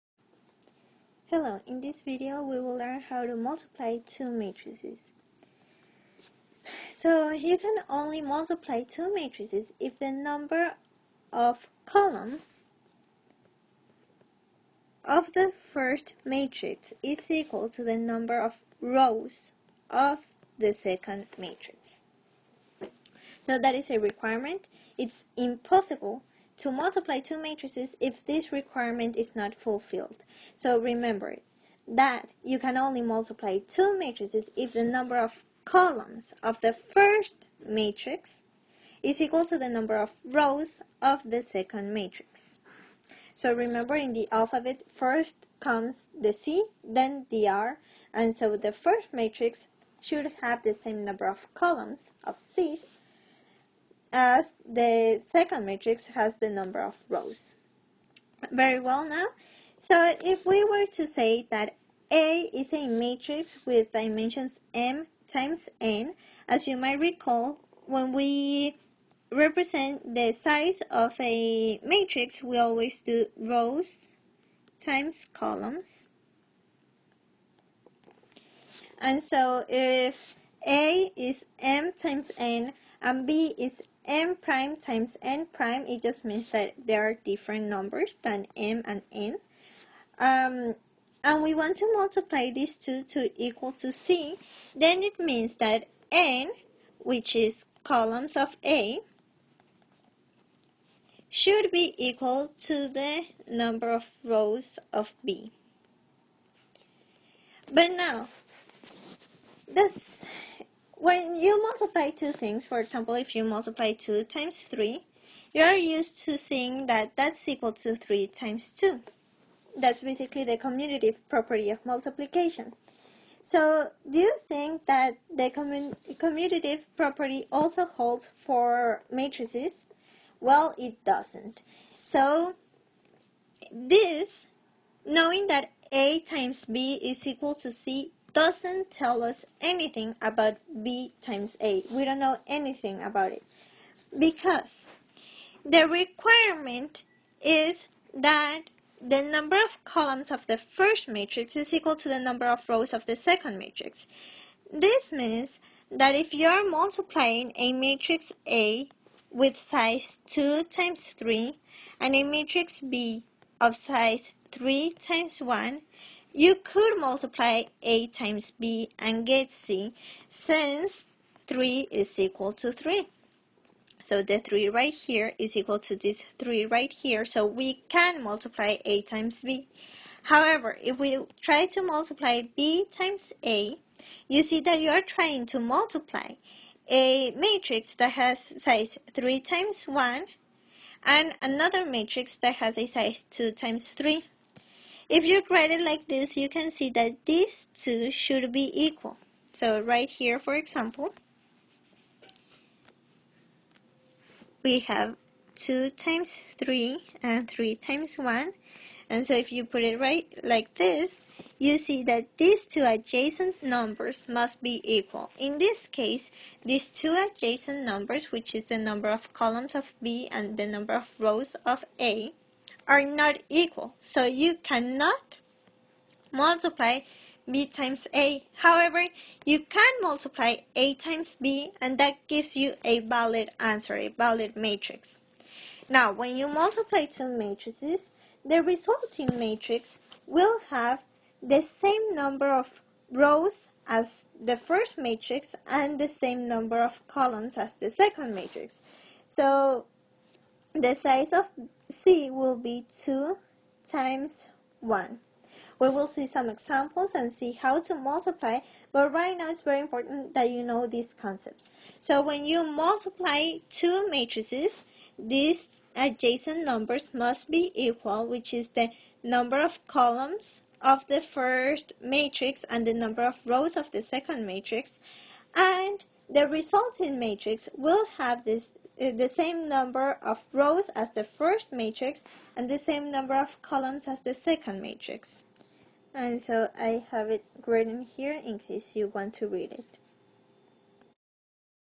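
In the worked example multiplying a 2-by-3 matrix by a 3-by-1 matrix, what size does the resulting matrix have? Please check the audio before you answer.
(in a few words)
2 times 1.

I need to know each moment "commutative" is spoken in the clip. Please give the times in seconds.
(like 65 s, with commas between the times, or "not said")
120 s, 125 s.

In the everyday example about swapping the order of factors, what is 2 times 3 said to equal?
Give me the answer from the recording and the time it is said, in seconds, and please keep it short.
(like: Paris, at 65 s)
3 times 2, at 117 s.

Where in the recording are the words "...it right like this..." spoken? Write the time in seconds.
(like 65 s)
209 s.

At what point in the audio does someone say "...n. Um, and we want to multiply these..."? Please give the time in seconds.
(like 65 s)
89 s.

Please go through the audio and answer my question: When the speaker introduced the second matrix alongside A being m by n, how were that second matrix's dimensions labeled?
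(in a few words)
m prime times n prime.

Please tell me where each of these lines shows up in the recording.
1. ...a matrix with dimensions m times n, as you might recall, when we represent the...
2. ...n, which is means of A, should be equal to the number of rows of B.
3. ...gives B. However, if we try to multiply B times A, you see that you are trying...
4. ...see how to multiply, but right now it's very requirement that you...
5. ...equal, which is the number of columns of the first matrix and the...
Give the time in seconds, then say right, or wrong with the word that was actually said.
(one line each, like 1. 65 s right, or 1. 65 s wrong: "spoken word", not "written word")
1. 62 s right
2. 96 s wrong: "columns", not "means"
3. 179 s wrong: "times", not "gives"
4. 257 s wrong: "important", not "requirement"
5. 267 s right.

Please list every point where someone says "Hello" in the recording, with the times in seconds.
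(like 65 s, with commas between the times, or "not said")
1 s.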